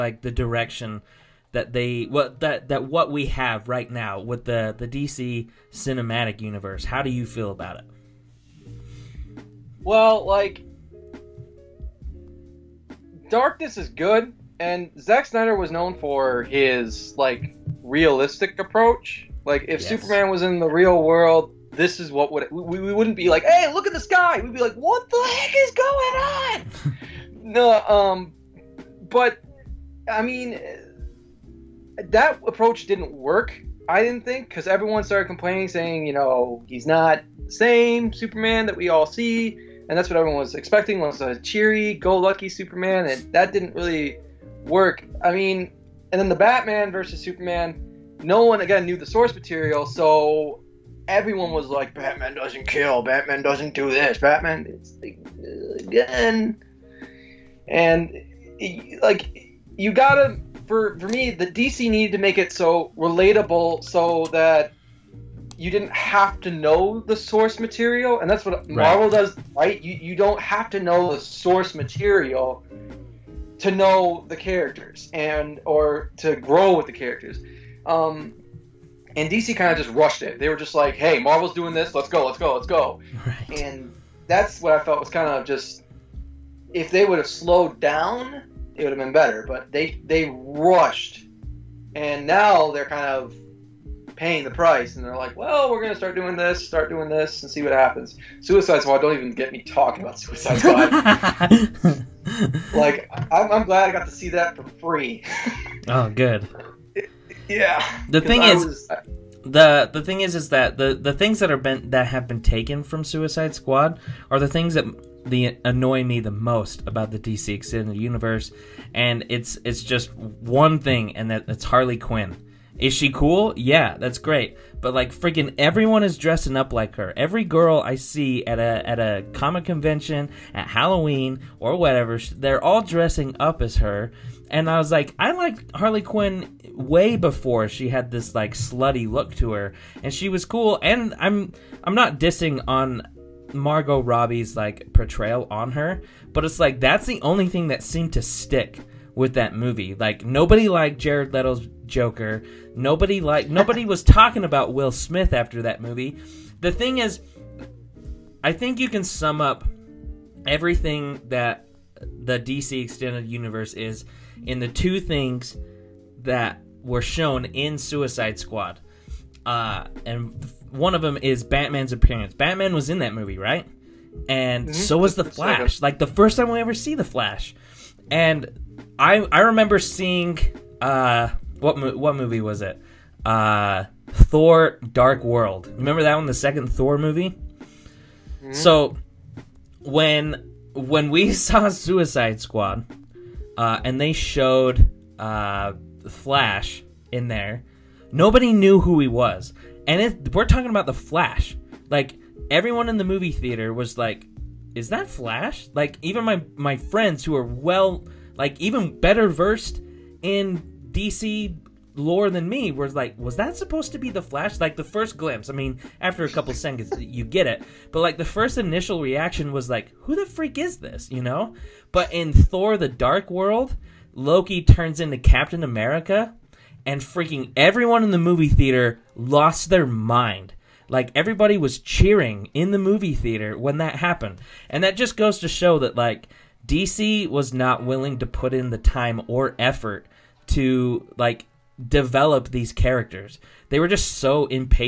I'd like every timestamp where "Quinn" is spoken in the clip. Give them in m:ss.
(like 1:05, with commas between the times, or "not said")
2:01, 2:16.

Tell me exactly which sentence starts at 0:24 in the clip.
We'd be like, what the heck is going on?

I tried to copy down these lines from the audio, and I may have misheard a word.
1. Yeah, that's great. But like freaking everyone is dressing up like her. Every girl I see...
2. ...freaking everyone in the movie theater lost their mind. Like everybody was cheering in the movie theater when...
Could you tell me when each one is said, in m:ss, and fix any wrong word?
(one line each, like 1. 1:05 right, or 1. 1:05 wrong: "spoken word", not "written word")
1. 2:03 right
2. 3:47 right.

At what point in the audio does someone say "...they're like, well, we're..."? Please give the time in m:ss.
1:35.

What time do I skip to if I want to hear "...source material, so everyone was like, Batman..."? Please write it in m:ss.
0:49.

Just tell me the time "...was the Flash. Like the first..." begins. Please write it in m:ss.
2:54.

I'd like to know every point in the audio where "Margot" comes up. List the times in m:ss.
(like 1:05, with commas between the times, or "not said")
2:23.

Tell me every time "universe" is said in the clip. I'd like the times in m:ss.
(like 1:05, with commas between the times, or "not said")
0:06, 1:57, 2:43.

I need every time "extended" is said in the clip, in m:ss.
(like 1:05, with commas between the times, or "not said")
1:57, 2:42.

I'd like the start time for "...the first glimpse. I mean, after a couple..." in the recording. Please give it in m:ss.
3:34.